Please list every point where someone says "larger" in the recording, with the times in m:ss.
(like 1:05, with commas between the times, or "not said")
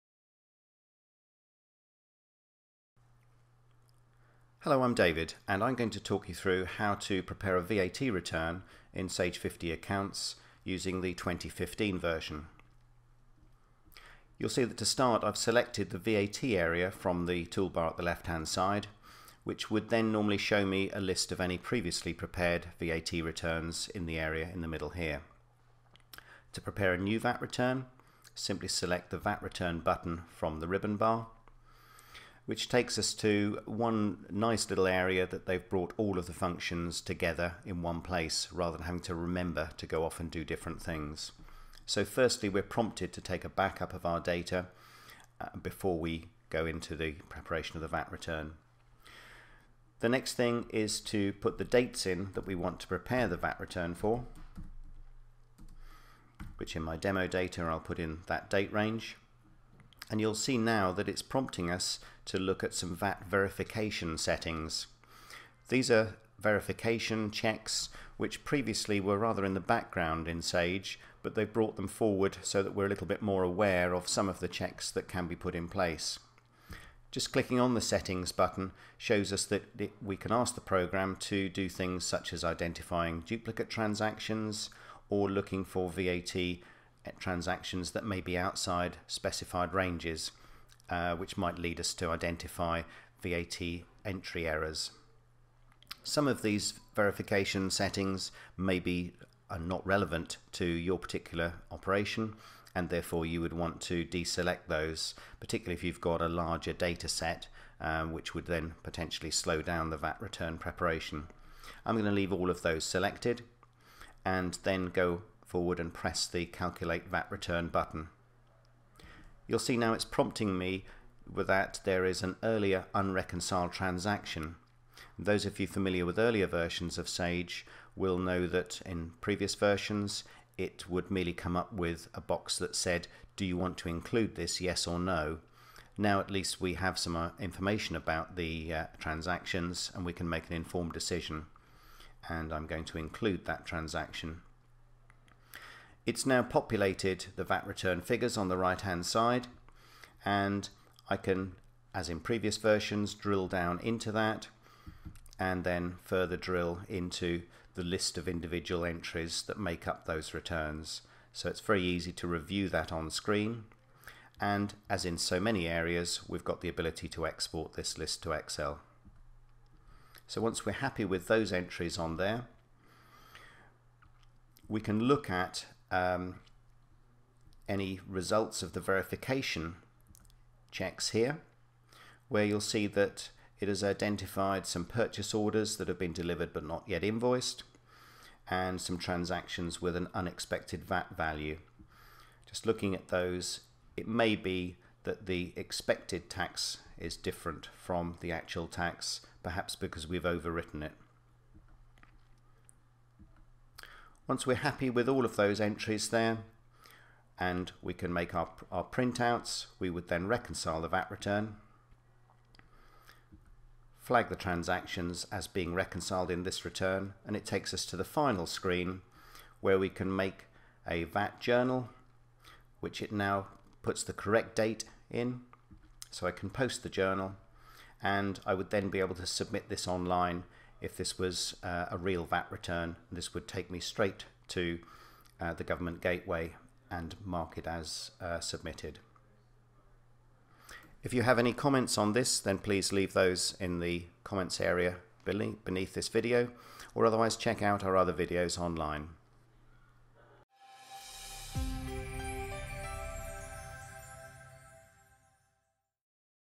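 1:46.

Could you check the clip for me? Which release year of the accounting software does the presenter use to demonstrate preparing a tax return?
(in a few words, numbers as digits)
2015.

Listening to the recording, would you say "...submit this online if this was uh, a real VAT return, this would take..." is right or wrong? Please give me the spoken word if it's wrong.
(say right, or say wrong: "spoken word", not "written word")
right.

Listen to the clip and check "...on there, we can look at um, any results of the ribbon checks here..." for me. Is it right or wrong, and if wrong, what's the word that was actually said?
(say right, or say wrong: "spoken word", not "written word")
wrong: "verification", not "ribbon".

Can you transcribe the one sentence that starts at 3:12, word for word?
Just looking at those, it may be that the expected tax is different from the actual tax, perhaps because we've overwritten it.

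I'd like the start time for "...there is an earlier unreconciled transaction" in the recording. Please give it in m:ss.
2:01.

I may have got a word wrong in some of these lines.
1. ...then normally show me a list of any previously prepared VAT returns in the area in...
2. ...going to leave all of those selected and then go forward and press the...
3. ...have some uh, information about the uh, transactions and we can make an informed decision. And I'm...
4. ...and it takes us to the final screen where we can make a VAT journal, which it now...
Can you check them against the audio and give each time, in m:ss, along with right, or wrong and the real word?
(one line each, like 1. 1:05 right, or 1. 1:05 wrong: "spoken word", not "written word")
1. 0:19 right
2. 1:51 right
3. 2:16 right
4. 3:37 right.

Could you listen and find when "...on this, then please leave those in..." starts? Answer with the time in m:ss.
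4:01.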